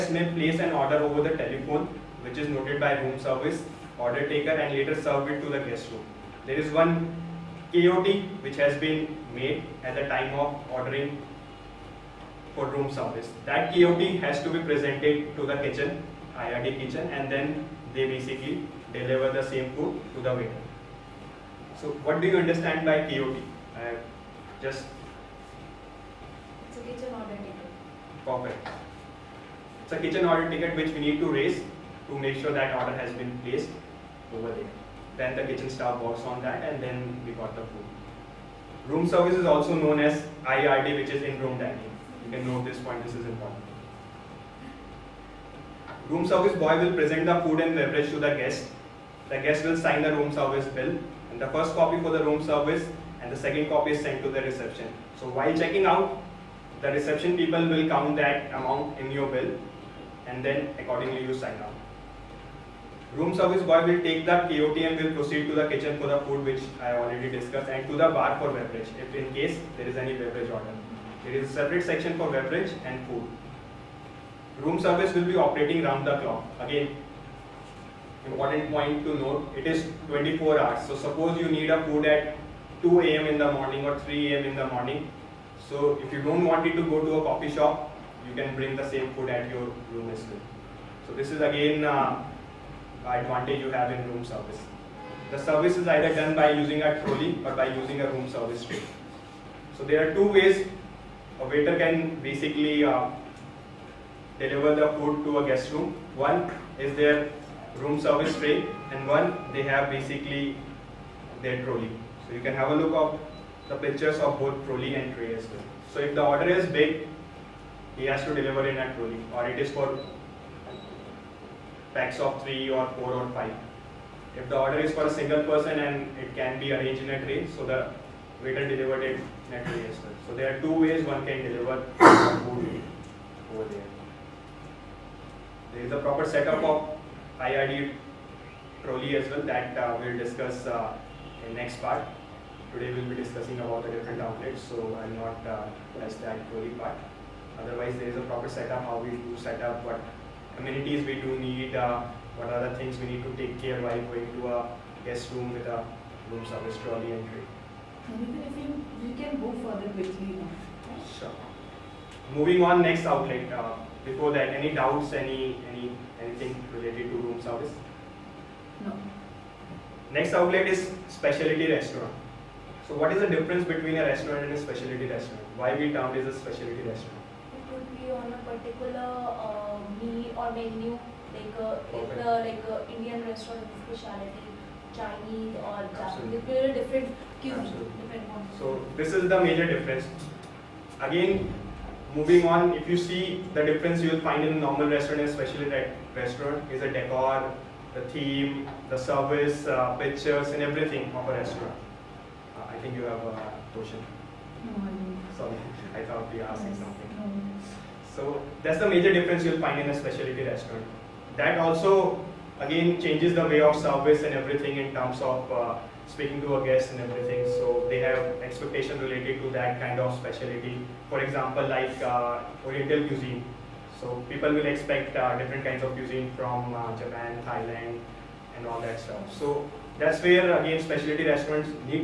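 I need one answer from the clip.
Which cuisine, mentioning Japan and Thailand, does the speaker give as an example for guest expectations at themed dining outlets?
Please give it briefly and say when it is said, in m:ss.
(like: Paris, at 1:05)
Oriental cuisine, at 3:42.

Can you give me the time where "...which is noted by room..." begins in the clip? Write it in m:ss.
0:02.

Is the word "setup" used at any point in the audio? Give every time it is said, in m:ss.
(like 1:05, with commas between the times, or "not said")
2:16, 2:28.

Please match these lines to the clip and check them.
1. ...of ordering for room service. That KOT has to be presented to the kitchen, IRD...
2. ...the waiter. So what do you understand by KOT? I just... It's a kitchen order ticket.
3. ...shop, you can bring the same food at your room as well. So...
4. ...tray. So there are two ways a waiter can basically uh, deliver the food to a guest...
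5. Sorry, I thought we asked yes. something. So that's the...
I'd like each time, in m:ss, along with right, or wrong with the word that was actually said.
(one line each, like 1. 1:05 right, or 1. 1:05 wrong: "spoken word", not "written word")
1. 0:10 right
2. 0:20 right
3. 1:27 right
4. 1:38 right
5. 3:25 right.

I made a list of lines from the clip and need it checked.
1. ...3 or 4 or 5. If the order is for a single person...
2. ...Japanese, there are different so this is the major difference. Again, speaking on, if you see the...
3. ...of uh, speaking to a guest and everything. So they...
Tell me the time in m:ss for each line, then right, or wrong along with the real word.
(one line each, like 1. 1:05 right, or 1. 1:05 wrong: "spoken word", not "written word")
1. 2:02 right
2. 3:05 wrong: "moving", not "speaking"
3. 3:35 right.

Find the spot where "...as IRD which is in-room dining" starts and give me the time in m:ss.
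0:40.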